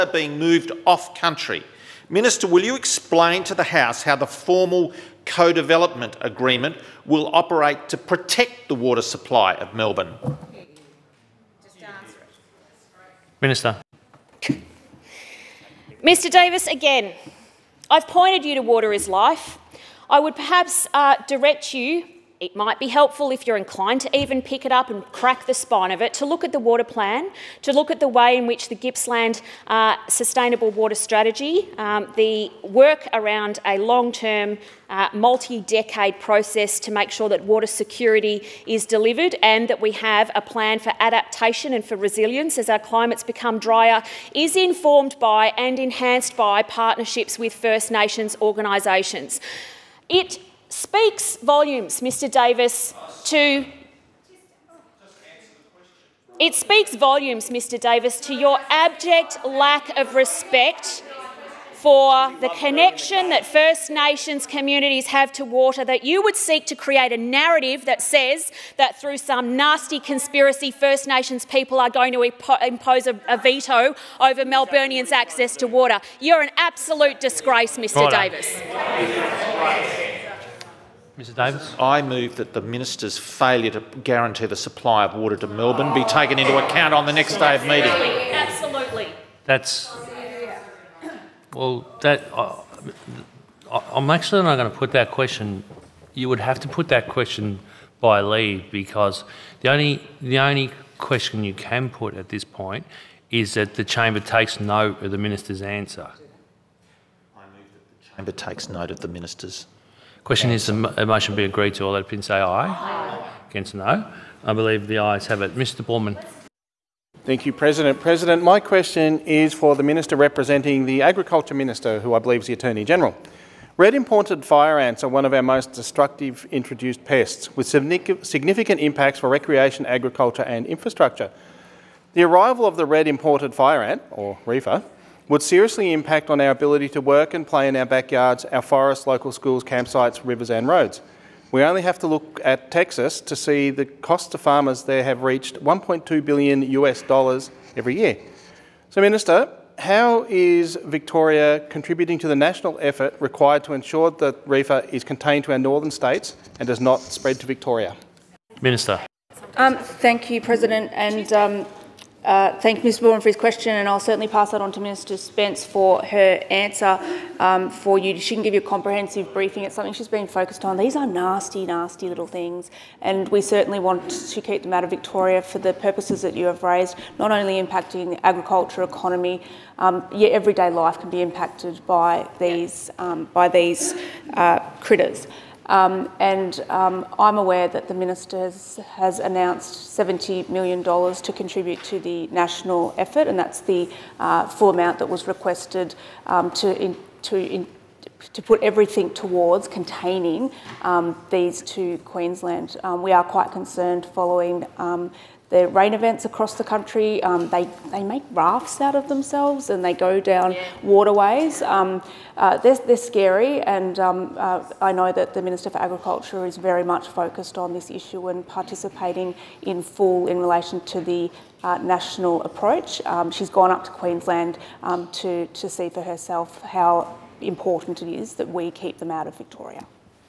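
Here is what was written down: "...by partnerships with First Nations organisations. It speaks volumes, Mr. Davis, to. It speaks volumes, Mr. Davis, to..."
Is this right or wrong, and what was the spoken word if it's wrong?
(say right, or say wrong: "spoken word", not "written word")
right.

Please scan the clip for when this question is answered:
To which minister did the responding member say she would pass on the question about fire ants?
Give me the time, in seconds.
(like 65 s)
164 s.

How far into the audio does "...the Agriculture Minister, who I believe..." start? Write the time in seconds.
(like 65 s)
120 s.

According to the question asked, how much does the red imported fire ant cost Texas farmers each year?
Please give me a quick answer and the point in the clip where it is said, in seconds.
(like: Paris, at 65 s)
1.2 billion US dollars, at 145 s.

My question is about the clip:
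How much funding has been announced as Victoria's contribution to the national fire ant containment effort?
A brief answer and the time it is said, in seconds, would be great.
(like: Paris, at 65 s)
$70 million, at 189 s.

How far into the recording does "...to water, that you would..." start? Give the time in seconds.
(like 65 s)
65 s.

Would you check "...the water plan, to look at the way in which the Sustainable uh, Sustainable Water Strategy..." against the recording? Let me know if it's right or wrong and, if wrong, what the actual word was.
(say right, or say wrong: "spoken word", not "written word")
wrong: "Gippsland", not "Sustainable".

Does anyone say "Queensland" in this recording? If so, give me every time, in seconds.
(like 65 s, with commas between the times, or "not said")
201 s, 223 s.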